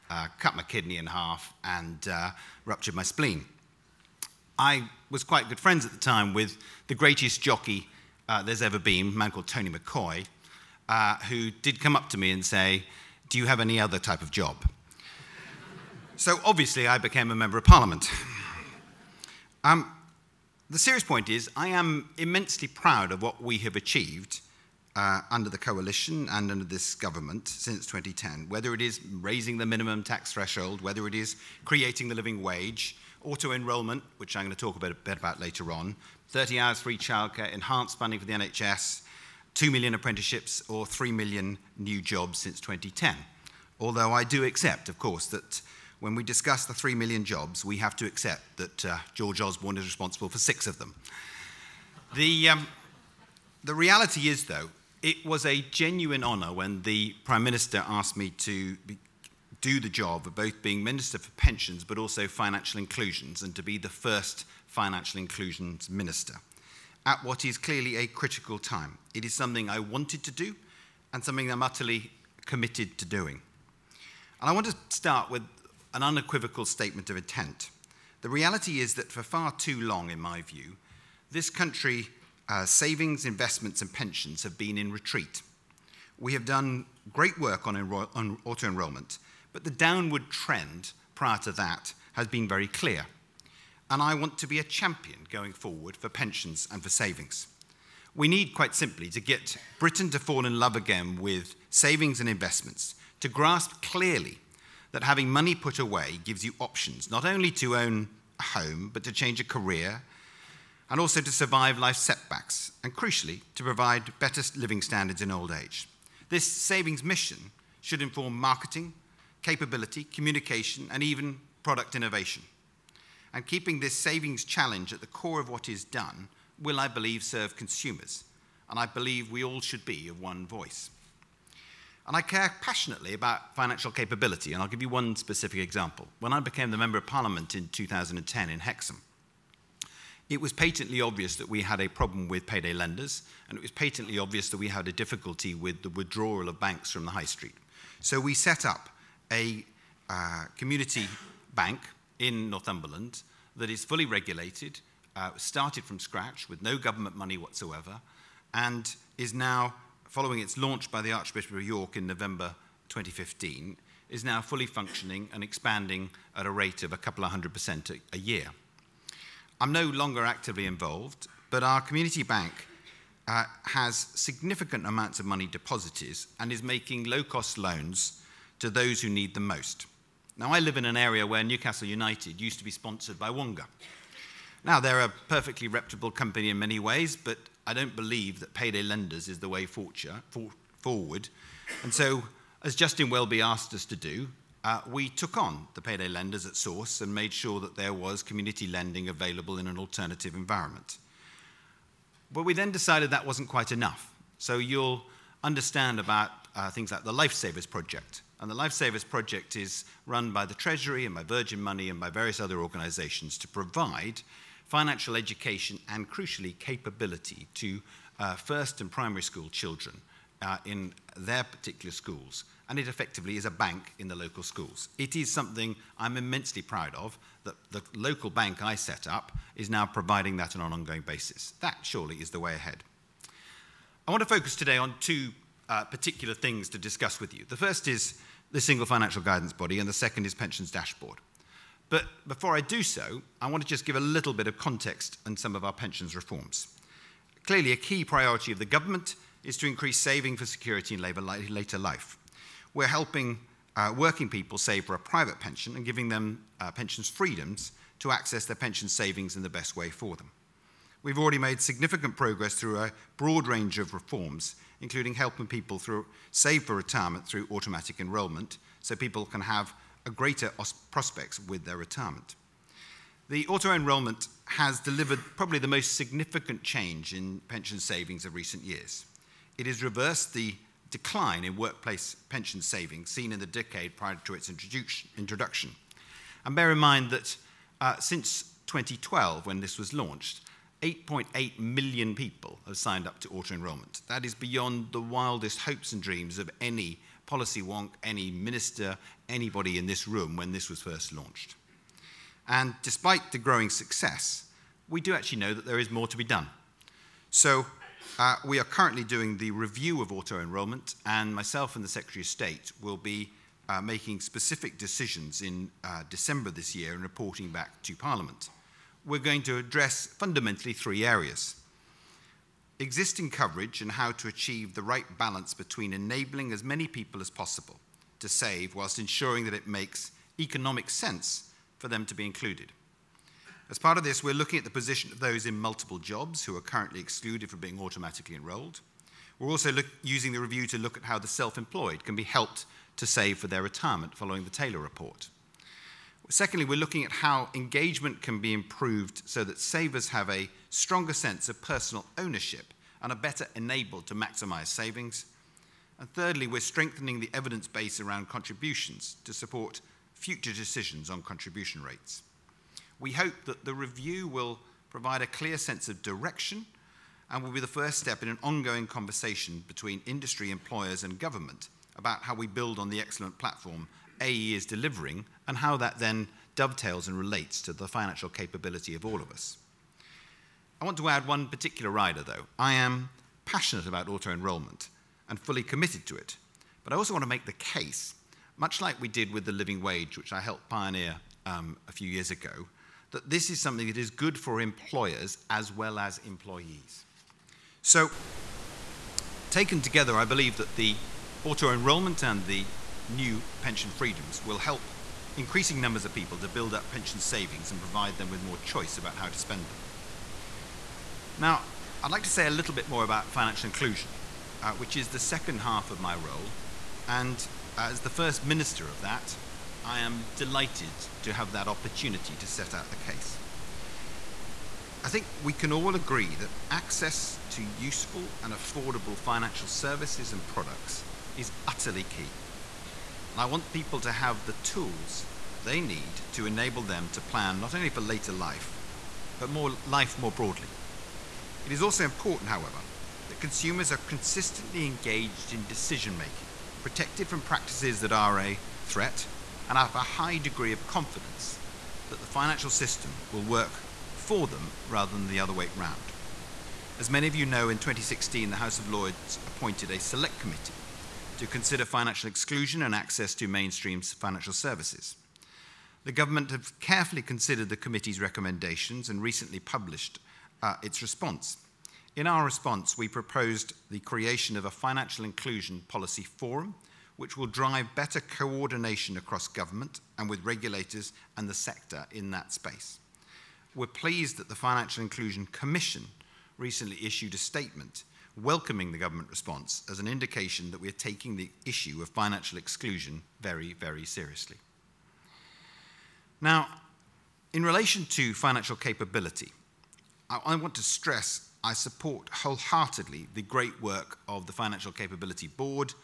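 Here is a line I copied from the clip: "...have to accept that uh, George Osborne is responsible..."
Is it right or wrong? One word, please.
right.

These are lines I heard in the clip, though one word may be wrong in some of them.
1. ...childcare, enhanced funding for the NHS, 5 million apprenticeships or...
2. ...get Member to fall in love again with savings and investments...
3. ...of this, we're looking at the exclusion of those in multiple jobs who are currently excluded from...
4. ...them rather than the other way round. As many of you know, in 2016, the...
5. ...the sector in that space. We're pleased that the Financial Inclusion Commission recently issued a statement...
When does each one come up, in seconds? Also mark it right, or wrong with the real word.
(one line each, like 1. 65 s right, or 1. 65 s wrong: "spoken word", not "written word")
1. 36 s wrong: "2", not "5"
2. 99 s wrong: "Britain", not "Member"
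3. 333 s wrong: "position", not "exclusion"
4. 454 s right
5. 481 s right.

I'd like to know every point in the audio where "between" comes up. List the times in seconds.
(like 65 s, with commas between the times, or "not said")
325 s, 369 s.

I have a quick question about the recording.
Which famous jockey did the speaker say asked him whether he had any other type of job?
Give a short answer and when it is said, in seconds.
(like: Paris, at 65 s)
Tony McCoy, at 9 s.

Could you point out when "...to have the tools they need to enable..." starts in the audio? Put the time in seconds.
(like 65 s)
433 s.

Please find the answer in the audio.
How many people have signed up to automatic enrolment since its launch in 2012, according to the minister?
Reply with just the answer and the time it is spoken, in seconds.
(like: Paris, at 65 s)
8.8 million, at 290 s.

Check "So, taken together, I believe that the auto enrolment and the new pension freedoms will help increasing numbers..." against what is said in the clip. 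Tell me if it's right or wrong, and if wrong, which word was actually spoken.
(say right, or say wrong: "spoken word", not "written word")
right.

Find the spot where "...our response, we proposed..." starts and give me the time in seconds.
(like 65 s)
472 s.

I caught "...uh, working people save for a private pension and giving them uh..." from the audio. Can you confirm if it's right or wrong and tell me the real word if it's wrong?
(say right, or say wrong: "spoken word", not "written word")
right.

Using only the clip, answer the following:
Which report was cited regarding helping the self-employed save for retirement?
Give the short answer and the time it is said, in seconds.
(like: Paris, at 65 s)
Taylor report, at 344 s.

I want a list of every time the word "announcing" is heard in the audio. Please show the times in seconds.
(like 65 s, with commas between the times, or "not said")
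not said.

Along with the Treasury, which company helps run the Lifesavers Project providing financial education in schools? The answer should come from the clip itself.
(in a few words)
Virgin Money.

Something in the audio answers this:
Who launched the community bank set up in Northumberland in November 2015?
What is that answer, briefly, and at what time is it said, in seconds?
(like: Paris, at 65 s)
Archbishop of York, at 161 s.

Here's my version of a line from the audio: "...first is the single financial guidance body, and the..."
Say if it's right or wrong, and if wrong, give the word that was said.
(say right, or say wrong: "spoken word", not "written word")
right.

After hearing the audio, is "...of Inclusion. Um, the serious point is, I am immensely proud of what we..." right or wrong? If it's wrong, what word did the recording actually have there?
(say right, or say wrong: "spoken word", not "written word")
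wrong: "Parliament", not "Inclusion".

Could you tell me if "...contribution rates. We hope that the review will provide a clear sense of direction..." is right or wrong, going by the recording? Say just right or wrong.
right.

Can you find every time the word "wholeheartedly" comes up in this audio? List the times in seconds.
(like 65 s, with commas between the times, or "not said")
502 s.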